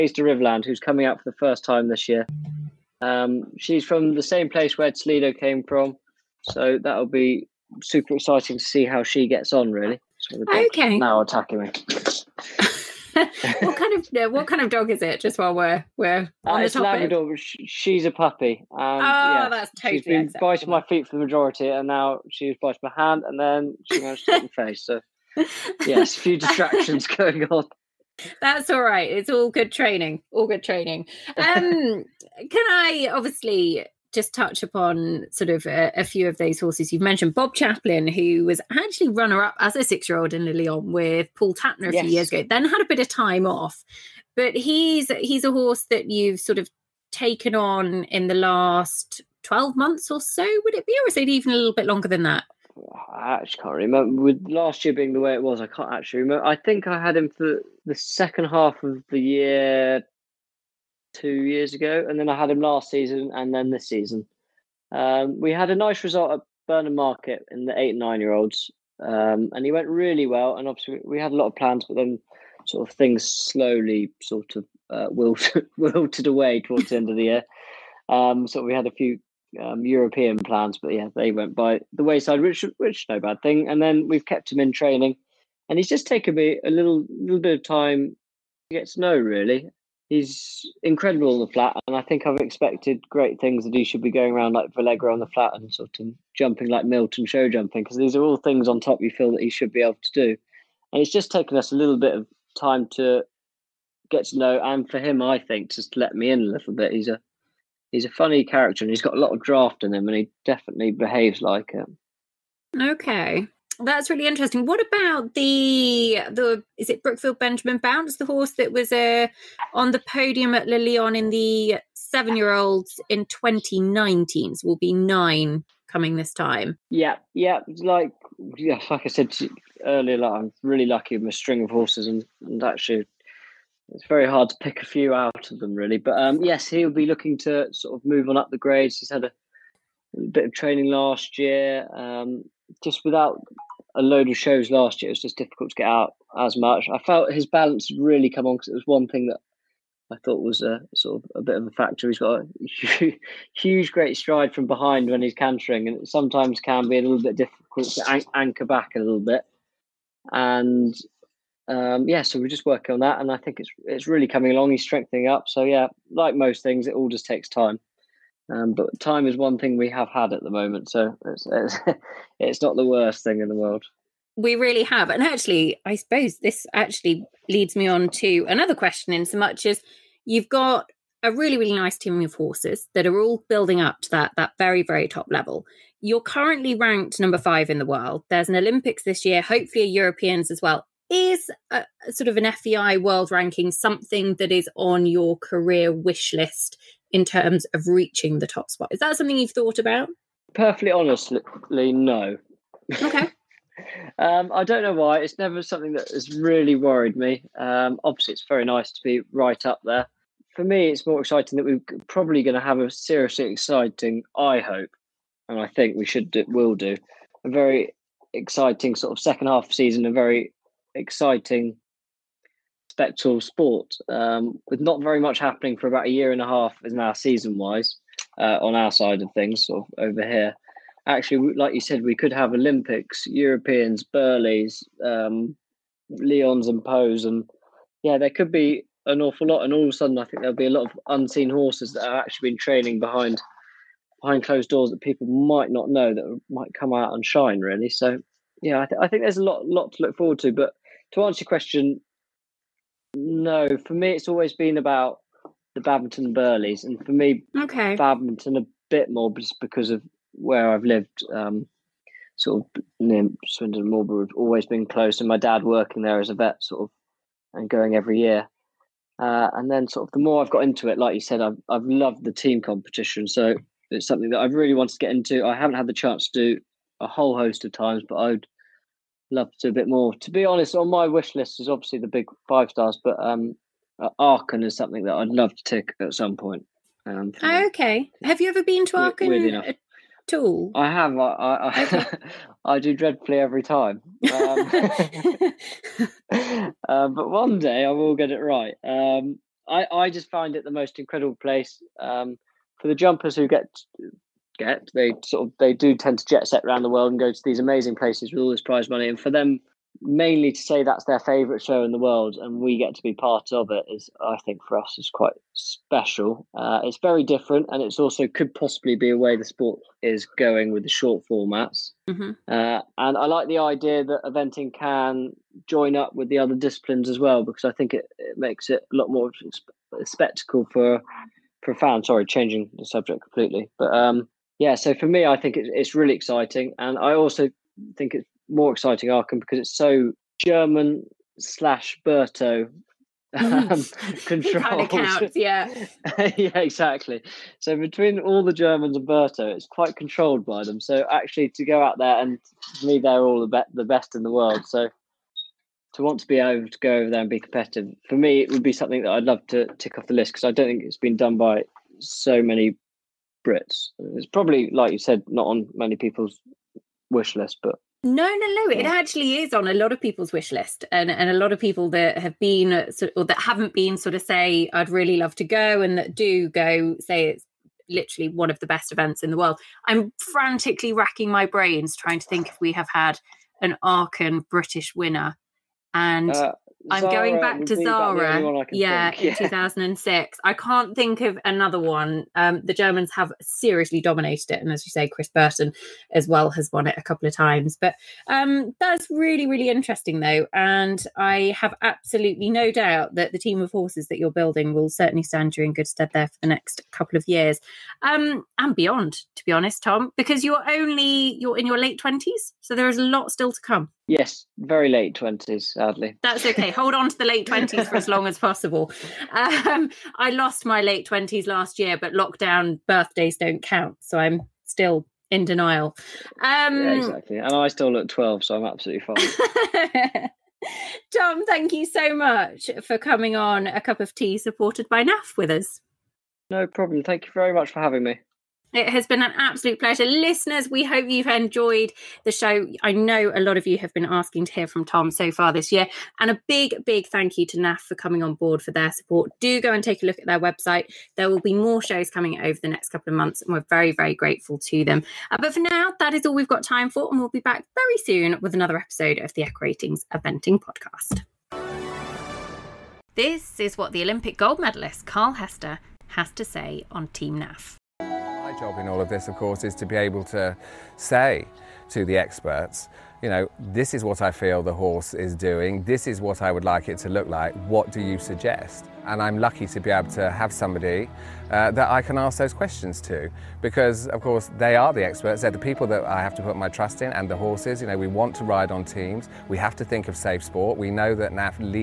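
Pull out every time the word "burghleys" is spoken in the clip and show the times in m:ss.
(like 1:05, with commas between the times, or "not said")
3:54, 4:16.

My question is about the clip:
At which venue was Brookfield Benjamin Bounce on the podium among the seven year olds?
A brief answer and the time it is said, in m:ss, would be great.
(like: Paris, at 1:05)
Le Lion, at 2:00.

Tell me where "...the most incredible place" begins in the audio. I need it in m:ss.
5:00.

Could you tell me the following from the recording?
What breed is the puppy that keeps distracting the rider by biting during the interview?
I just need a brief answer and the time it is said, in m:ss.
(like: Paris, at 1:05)
Labrador, at 0:17.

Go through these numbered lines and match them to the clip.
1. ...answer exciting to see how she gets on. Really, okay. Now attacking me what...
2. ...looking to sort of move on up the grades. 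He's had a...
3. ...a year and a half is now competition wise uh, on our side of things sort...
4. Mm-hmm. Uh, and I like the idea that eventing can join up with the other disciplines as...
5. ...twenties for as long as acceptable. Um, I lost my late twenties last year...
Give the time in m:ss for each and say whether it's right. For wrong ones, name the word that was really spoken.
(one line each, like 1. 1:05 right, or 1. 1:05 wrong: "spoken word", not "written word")
1. 0:07 wrong: "super", not "answer"
2. 2:17 right
3. 3:46 wrong: "season", not "competition"
4. 5:22 right
5. 6:57 wrong: "possible", not "acceptable".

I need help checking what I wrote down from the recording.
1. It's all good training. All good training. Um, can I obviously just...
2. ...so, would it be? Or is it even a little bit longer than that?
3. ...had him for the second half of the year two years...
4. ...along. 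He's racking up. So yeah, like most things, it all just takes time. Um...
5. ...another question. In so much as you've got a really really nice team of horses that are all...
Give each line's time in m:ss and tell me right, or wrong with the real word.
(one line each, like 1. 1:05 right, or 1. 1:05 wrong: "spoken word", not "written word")
1. 0:29 right
2. 0:50 right
3. 0:57 right
4. 2:44 wrong: "strengthening", not "racking"
5. 2:58 right.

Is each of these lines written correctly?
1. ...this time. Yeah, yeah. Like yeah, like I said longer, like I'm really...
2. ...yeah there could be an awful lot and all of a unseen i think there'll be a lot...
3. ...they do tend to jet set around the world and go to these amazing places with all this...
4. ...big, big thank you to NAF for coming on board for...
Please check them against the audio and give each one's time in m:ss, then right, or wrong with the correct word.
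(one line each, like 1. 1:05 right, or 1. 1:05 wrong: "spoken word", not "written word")
1. 2:06 wrong: "earlier", not "longer"
2. 3:58 wrong: "sudden", not "unseen"
3. 5:05 right
4. 7:26 right.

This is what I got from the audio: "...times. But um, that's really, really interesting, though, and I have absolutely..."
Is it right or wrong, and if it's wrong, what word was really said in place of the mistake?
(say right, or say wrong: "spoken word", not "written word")
right.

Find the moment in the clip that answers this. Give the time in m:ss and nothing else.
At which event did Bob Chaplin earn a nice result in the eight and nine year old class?
1:06.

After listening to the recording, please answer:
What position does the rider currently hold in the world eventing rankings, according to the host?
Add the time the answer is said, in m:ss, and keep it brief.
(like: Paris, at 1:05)
5, at 3:07.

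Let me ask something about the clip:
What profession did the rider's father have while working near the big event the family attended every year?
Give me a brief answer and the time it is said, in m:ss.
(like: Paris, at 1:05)
vet, at 4:26.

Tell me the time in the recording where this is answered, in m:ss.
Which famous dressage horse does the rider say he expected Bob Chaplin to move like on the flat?
1:34.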